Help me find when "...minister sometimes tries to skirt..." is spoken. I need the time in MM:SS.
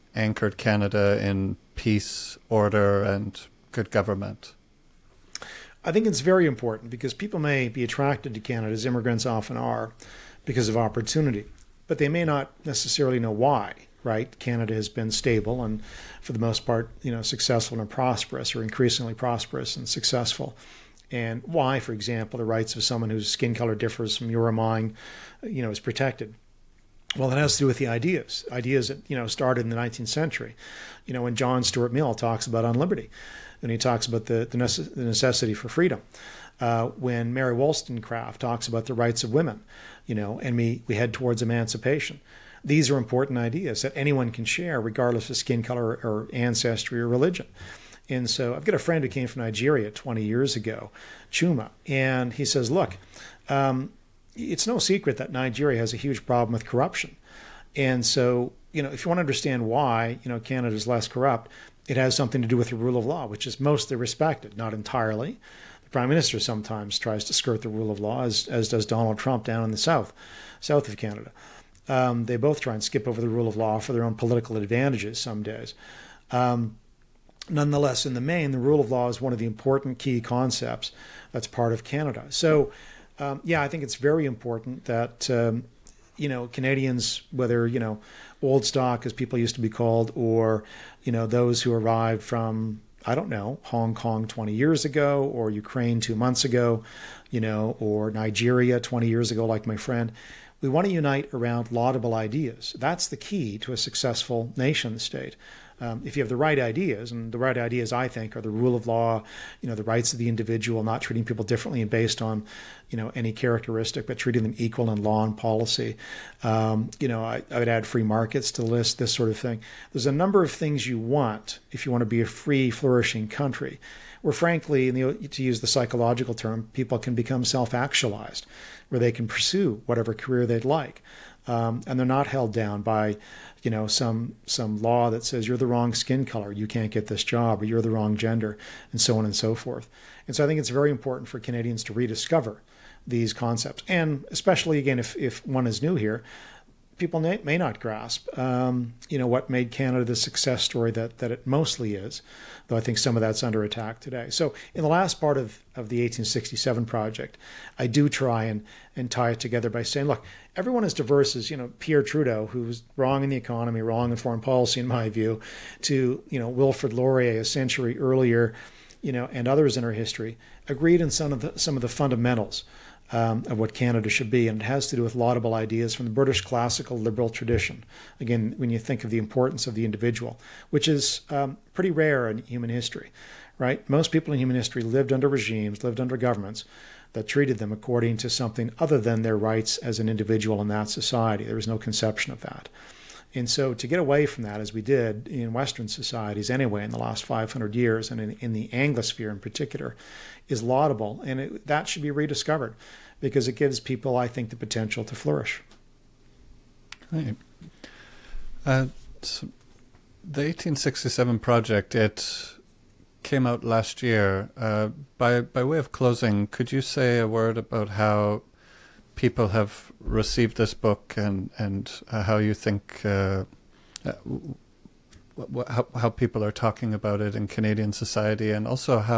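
01:06.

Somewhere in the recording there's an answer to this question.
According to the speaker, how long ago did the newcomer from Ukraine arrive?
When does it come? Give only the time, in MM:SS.
01:36.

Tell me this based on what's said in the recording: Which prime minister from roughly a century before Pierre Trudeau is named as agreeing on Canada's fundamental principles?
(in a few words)
Wilfrid Laurier.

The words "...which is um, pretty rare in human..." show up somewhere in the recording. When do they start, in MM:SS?
03:00.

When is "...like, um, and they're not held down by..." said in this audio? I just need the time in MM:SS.
02:10.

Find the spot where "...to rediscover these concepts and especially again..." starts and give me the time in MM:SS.
02:21.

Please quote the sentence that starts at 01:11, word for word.
Um, they both try and skip over the rule of law for their own political advantages some days.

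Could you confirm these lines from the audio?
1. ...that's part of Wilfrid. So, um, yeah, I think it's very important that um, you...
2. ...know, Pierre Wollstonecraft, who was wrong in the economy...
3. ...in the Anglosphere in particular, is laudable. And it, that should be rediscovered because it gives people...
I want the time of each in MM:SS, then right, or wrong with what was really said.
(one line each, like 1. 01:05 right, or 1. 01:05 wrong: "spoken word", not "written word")
1. 01:21 wrong: "Canada", not "Wilfrid"
2. 02:41 wrong: "Trudeau", not "Wollstonecraft"
3. 03:18 right.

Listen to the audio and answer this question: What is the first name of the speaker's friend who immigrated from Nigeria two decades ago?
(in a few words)
Chuma.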